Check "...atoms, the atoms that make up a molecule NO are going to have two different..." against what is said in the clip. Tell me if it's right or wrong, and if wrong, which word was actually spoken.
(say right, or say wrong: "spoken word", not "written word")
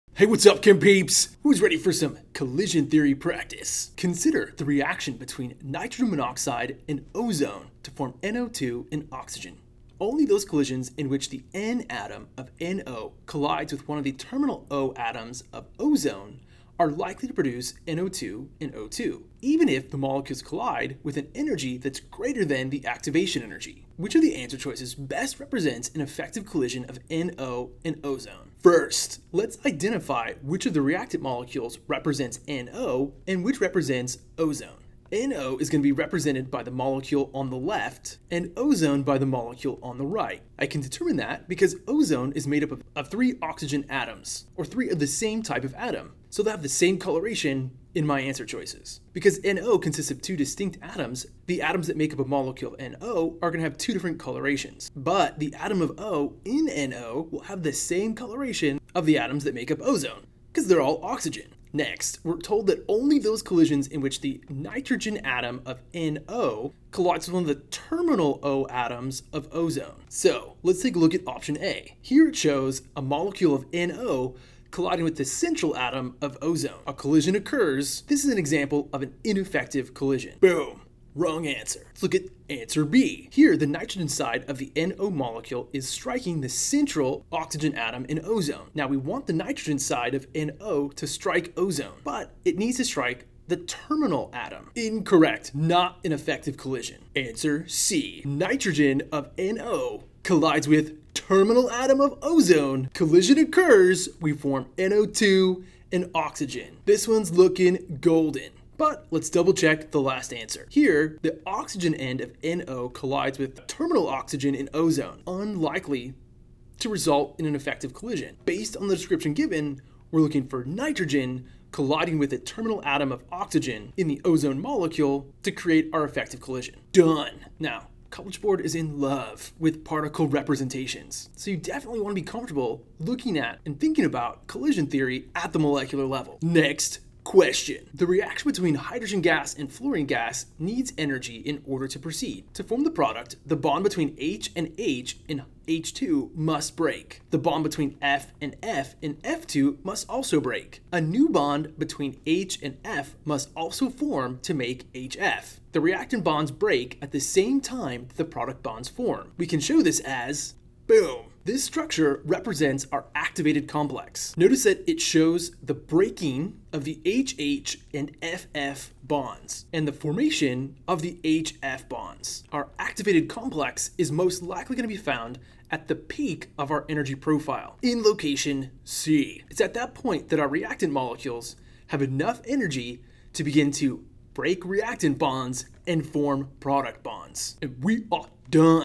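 right.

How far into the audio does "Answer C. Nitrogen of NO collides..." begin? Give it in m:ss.
1:37.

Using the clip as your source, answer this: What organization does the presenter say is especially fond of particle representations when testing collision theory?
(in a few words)
College Board.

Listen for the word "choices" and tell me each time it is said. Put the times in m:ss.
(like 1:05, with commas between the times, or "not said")
0:24, 0:48.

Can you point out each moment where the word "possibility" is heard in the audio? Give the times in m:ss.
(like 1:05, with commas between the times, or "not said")
not said.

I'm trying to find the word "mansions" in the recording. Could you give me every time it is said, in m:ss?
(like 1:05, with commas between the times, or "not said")
not said.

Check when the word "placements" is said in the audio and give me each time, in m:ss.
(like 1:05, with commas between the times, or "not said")
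not said.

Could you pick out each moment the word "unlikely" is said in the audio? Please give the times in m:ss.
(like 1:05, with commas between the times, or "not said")
1:55.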